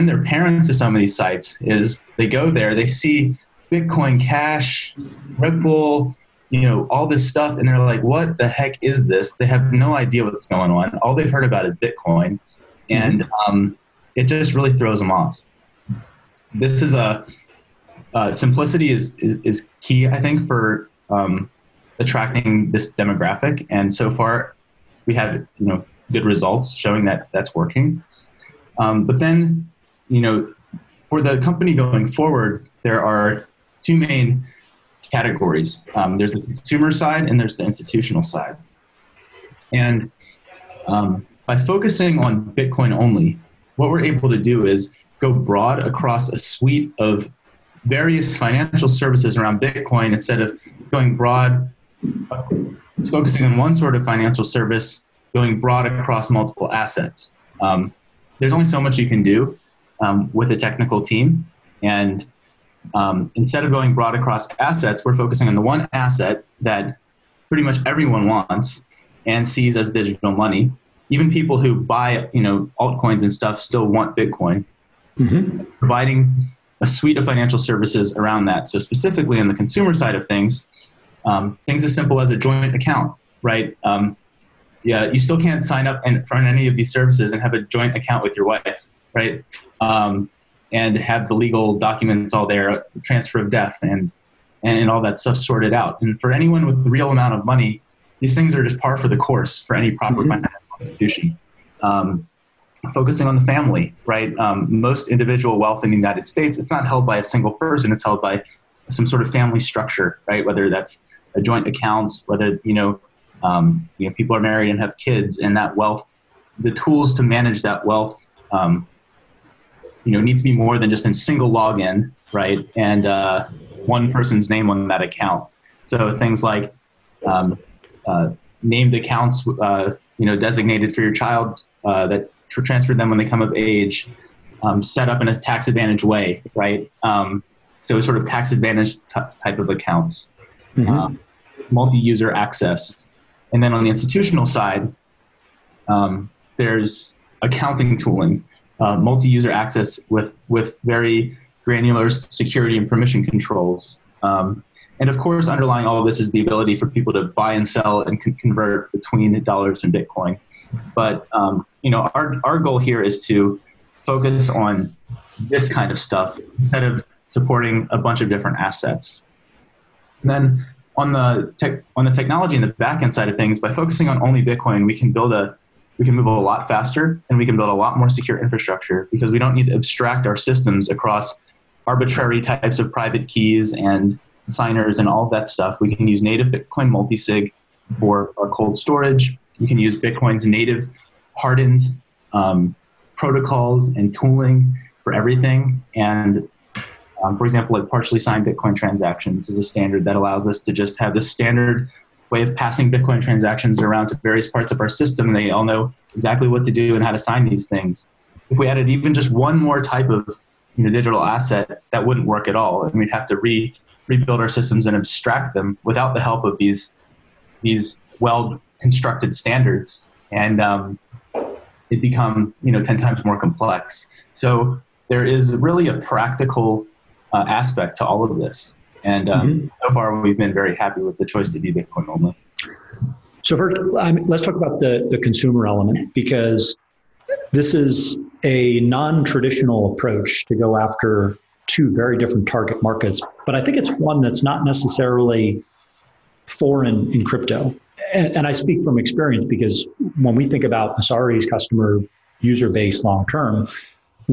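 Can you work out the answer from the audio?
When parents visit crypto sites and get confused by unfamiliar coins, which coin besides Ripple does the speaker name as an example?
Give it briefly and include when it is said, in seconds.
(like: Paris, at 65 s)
Bitcoin Cash, at 3 s.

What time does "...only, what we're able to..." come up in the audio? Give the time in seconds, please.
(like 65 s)
42 s.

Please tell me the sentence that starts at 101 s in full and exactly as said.
Um, focusing on the family, right?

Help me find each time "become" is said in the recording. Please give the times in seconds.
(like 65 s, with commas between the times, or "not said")
222 s.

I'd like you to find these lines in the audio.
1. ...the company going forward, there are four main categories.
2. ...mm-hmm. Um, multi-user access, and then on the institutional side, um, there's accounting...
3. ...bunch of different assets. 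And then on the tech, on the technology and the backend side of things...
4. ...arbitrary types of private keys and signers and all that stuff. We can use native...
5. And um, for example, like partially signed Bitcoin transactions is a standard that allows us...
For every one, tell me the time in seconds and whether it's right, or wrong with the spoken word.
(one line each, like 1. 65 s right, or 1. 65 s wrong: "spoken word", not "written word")
1. 31 s wrong: "two", not "four"
2. 140 s right
3. 167 s right
4. 181 s right
5. 195 s right.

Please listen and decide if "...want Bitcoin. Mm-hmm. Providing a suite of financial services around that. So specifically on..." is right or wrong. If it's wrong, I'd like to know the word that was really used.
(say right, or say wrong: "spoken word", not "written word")
right.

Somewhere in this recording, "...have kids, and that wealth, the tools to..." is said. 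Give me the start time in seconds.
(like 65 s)
114 s.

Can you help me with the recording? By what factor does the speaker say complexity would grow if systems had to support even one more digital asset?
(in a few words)
10 times.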